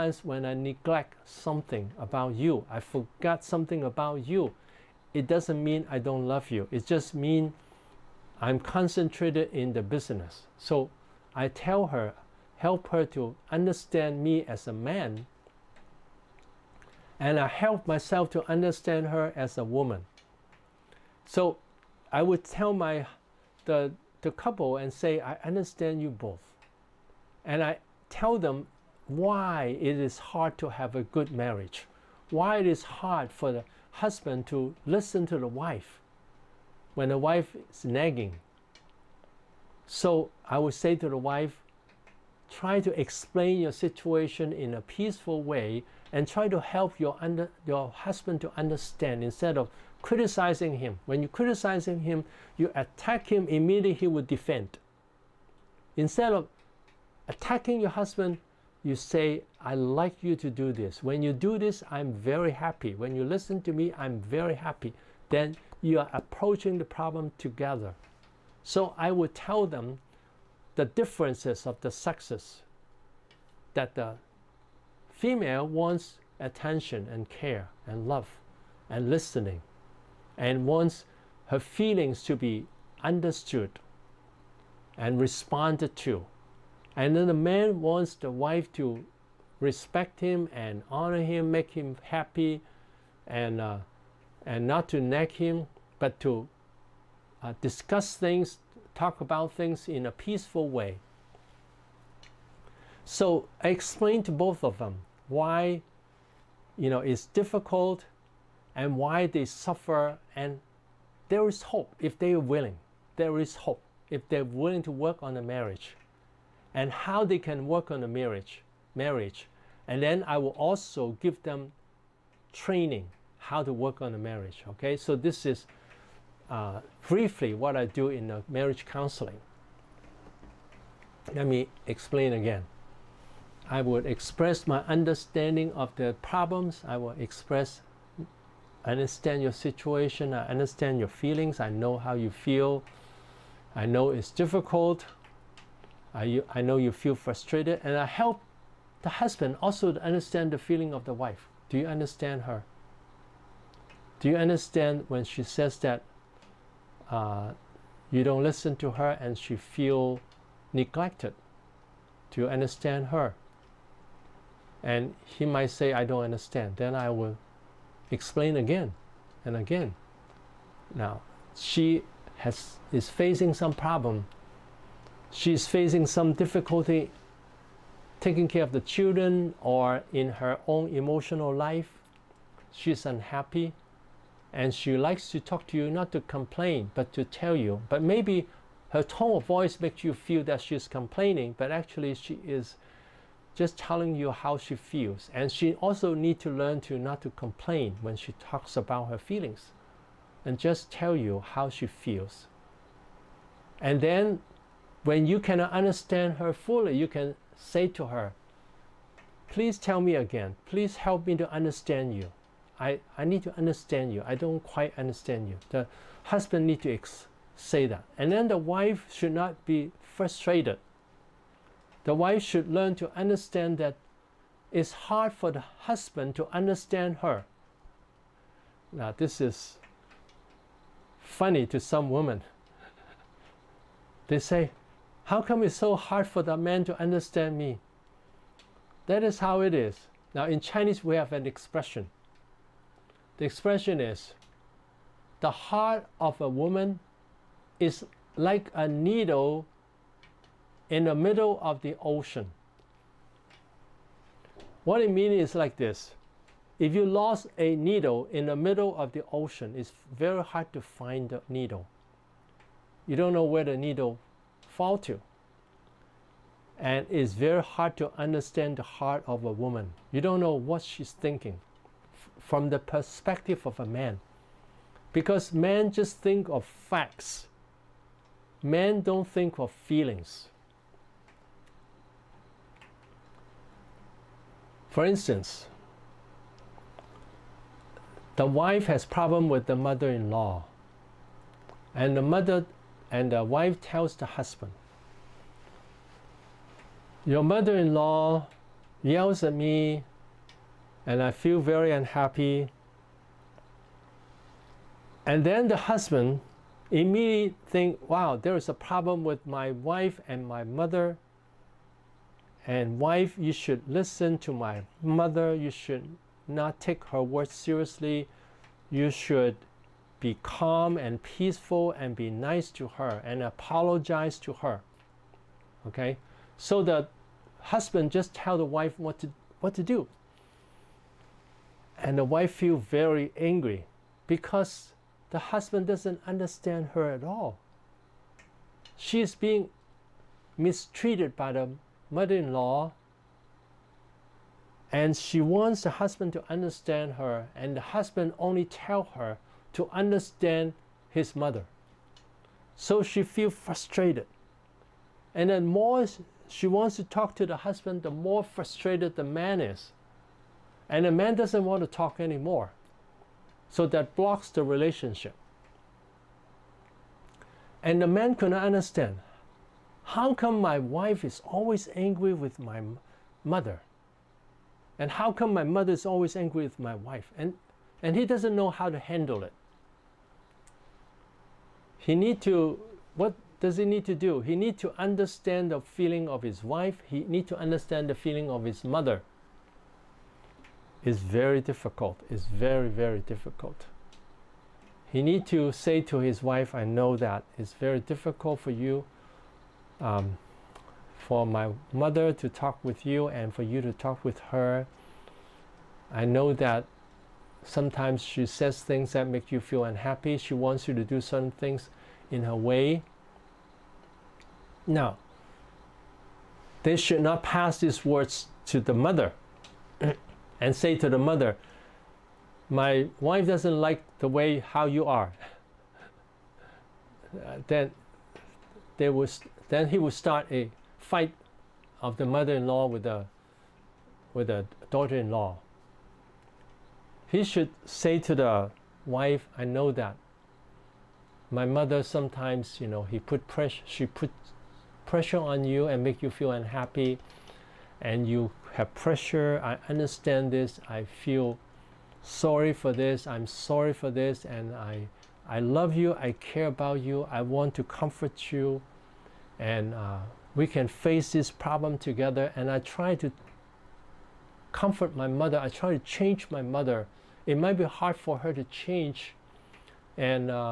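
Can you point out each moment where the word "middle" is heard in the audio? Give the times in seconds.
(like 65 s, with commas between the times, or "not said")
251 s, 258 s.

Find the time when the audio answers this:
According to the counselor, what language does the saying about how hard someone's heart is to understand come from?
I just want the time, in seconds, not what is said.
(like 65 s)
240 s.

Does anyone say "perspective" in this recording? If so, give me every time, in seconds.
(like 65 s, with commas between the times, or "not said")
272 s.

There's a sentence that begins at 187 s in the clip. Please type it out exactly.
But maybe her tone of voice makes you feel that she's complaining, but actually she is just telling you how she feels.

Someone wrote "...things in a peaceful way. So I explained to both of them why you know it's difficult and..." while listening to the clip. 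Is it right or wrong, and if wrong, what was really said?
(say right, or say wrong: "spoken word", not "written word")
right.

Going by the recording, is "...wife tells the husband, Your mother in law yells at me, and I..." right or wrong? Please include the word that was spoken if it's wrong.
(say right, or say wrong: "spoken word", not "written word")
right.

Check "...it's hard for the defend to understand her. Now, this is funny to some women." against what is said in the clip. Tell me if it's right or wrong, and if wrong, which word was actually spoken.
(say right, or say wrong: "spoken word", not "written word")
wrong: "husband", not "defend".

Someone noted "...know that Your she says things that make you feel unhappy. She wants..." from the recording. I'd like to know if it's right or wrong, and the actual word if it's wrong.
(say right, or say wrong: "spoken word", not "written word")
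wrong: "Sometimes", not "Your".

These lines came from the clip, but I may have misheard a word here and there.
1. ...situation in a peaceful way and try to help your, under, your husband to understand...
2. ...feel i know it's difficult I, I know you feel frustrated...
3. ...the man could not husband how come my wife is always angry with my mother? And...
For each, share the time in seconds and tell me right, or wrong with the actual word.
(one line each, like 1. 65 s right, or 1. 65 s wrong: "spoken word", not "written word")
1. 43 s right
2. 142 s right
3. 368 s wrong: "understand", not "husband".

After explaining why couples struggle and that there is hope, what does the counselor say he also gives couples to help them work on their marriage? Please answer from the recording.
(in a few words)
training.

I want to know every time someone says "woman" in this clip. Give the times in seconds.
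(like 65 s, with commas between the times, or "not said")
19 s, 246 s, 269 s.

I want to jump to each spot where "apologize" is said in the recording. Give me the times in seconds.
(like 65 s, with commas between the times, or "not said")
323 s.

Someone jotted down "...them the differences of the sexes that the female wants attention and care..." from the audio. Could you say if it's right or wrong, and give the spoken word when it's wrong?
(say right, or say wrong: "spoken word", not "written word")
right.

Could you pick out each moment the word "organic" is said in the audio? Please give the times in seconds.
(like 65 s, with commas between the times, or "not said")
not said.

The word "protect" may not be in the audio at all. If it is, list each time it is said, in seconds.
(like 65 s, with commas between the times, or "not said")
not said.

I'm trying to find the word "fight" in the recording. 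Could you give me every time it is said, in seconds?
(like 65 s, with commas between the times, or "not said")
430 s.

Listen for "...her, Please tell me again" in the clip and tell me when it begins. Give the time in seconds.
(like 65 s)
208 s.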